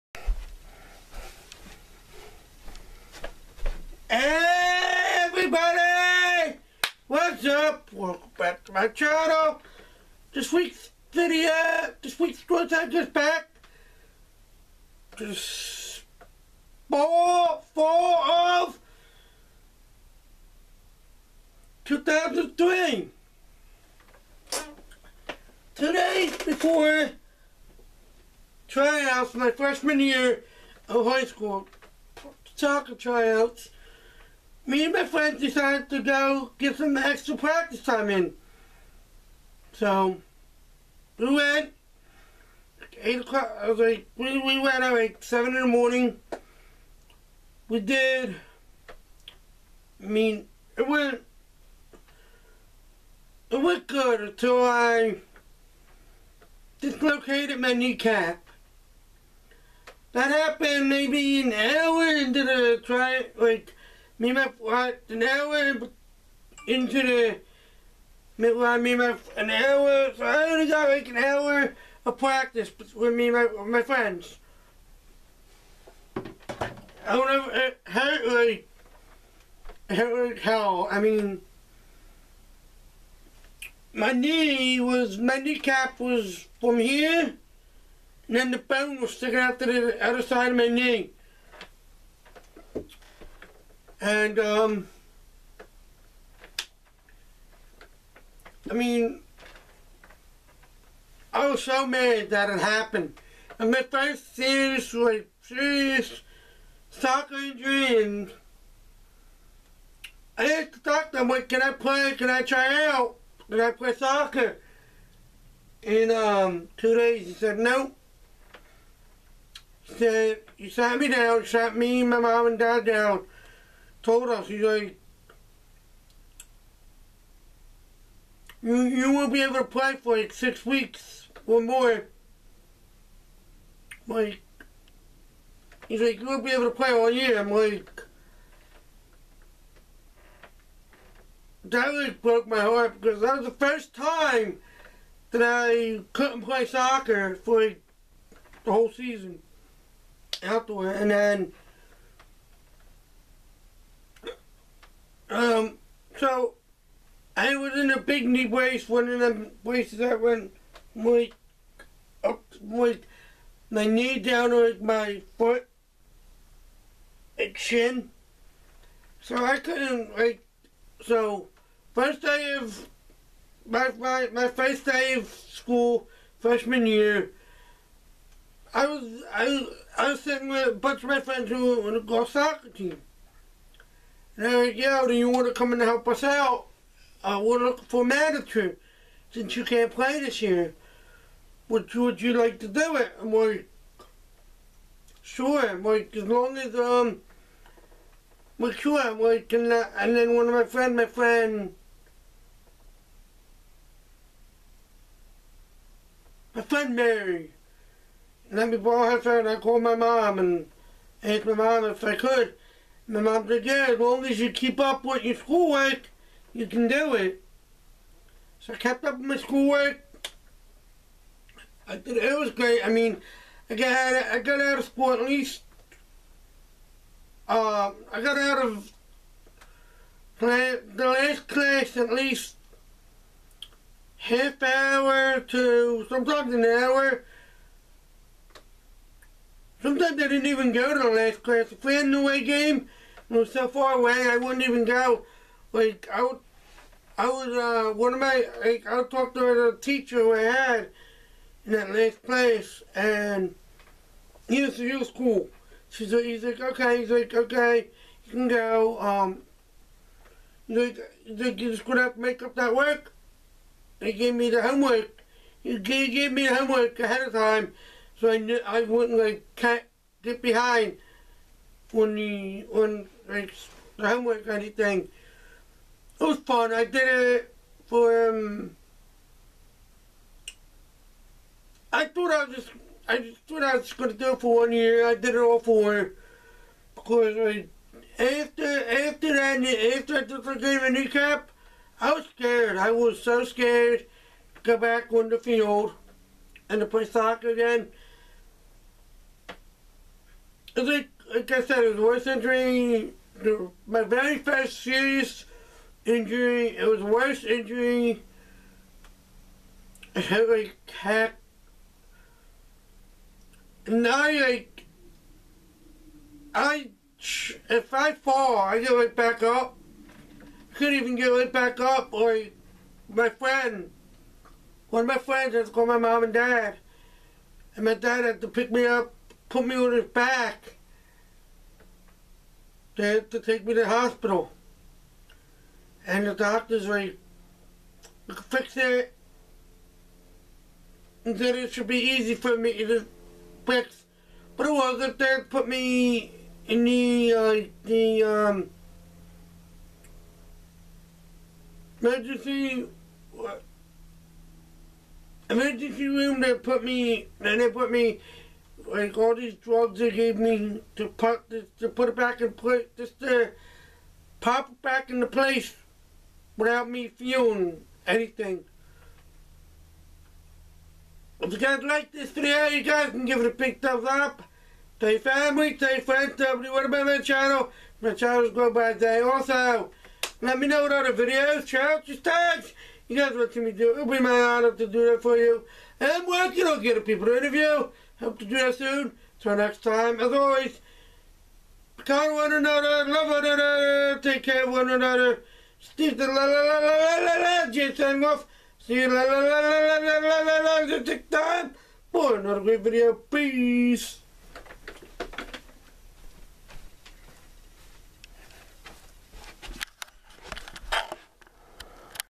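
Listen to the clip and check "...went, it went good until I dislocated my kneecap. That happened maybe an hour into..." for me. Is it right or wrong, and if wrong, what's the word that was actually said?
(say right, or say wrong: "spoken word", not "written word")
right.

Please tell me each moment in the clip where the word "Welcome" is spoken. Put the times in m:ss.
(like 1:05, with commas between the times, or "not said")
0:07.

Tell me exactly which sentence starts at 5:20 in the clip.
I couldn't even get right back up.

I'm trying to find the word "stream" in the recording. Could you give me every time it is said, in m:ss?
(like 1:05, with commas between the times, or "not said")
not said.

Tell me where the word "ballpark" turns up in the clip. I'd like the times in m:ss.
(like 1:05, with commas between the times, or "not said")
not said.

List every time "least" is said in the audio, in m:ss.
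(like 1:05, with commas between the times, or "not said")
3:45, 3:52.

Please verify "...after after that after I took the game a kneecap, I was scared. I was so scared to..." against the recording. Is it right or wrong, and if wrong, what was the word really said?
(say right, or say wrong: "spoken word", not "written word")
right.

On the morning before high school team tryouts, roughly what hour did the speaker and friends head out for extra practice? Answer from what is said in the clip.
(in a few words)
7.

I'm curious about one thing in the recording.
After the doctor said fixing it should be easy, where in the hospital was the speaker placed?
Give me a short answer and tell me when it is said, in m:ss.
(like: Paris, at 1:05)
Emergency room, at 5:55.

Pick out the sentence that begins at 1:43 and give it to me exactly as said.
And my first serious was serious soccer injury and I asked the doctor, like, can I play?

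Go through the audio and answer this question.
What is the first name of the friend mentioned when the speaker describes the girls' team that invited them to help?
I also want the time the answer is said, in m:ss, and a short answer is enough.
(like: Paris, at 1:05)
Mary, at 3:26.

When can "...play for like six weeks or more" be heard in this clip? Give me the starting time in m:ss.
2:09.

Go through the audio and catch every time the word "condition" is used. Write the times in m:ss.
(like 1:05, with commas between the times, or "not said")
not said.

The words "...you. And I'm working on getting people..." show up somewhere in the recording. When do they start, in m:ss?
6:25.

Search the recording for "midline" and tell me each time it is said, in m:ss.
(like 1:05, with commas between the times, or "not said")
1:08.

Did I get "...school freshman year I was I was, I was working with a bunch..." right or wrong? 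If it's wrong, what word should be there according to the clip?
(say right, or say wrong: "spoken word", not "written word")
wrong: "sitting", not "working".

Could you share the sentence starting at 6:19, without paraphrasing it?
Also, let me know what other videos, your tags.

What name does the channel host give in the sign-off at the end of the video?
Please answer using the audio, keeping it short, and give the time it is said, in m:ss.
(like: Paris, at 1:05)
Jason Wolf, at 6:37.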